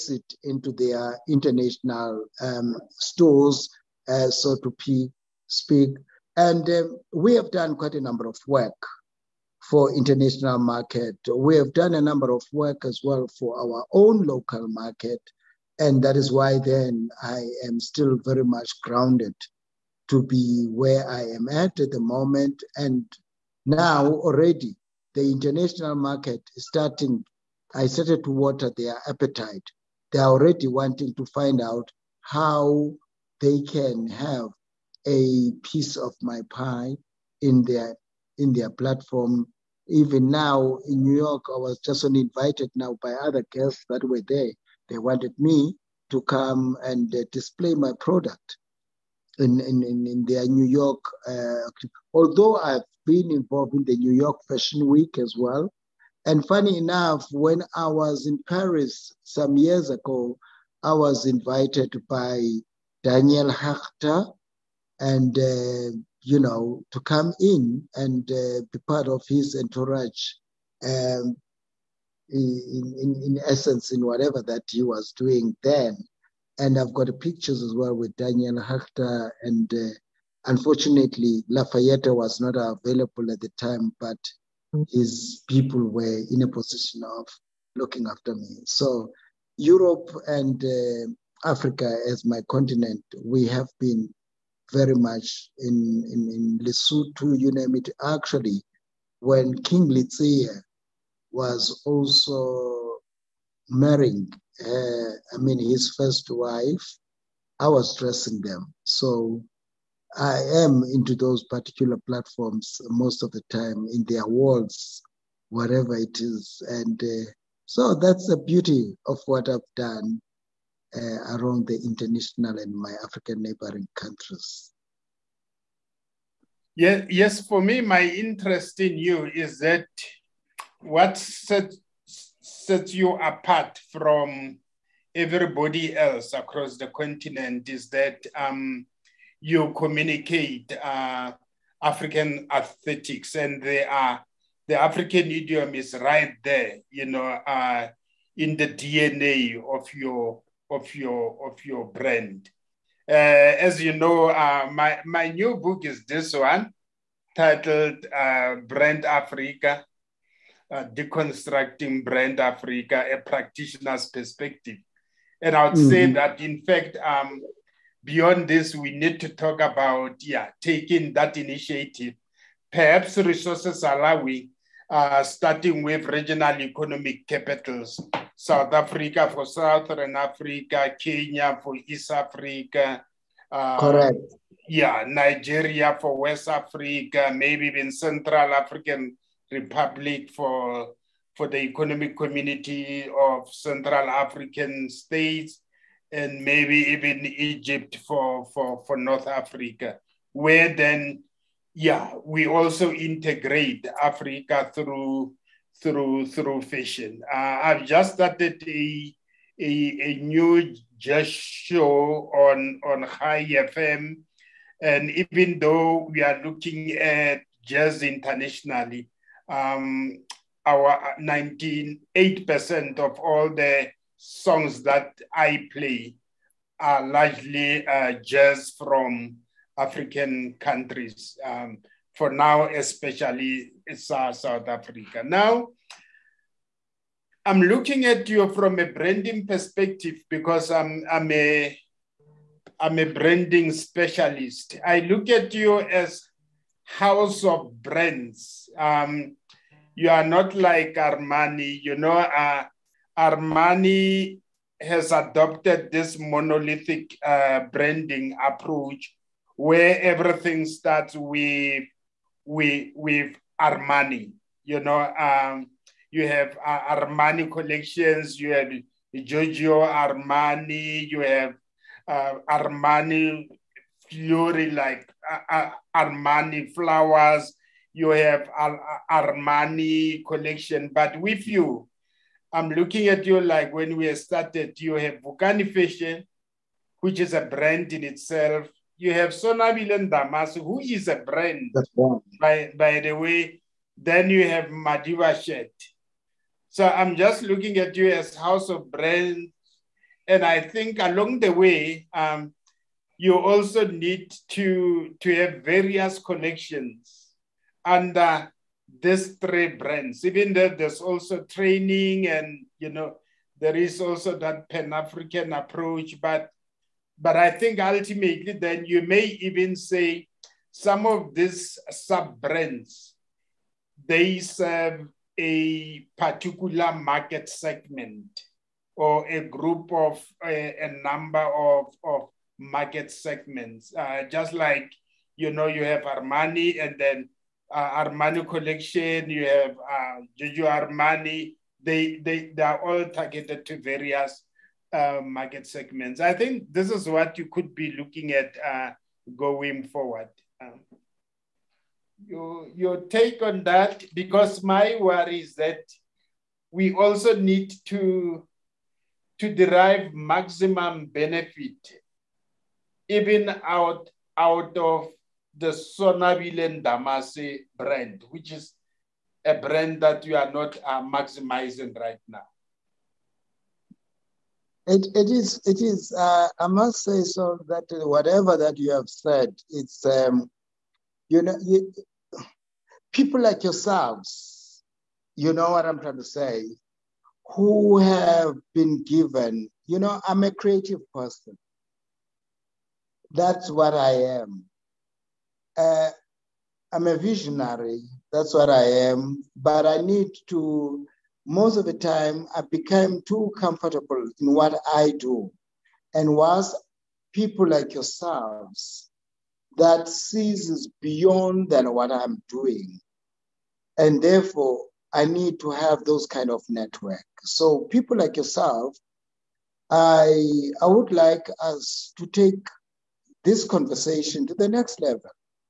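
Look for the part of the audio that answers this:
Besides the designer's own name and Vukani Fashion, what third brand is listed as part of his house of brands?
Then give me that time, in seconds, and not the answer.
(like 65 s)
294 s.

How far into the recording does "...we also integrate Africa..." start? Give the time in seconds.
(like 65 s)
202 s.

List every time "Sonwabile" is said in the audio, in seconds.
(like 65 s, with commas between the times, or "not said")
289 s, 365 s.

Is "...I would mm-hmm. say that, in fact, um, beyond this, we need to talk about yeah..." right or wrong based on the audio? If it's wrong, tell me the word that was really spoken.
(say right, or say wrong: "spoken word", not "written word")
right.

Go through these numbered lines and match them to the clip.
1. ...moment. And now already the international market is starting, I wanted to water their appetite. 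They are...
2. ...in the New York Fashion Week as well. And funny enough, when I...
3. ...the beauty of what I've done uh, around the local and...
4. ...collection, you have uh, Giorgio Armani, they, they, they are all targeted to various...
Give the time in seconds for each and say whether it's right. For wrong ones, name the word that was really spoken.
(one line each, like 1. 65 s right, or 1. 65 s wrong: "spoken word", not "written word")
1. 22 s wrong: "started", not "wanted"
2. 53 s right
3. 118 s wrong: "international", not "local"
4. 338 s right.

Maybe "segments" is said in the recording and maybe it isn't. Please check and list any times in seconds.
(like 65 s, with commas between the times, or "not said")
327 s, 333 s, 345 s.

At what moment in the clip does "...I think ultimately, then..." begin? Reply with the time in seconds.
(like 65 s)
317 s.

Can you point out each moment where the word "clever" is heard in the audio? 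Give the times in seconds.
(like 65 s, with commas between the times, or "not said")
not said.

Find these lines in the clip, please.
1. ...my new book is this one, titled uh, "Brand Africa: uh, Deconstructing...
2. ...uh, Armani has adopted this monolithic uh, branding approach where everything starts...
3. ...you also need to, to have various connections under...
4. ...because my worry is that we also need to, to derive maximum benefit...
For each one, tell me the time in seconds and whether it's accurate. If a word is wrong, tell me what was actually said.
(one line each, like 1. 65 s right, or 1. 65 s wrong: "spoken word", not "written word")
1. 155 s right
2. 252 s right
3. 303 s right
4. 354 s right.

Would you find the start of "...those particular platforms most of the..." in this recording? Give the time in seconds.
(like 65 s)
111 s.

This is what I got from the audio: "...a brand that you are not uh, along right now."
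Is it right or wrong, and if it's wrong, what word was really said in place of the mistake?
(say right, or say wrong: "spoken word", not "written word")
wrong: "maximizing", not "along".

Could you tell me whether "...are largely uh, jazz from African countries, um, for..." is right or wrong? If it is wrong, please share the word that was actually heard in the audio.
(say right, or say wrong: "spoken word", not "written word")
right.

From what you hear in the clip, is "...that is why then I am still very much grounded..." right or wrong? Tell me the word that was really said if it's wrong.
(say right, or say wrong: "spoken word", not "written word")
right.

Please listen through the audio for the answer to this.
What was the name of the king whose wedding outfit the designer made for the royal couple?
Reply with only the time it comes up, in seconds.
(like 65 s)
99 s.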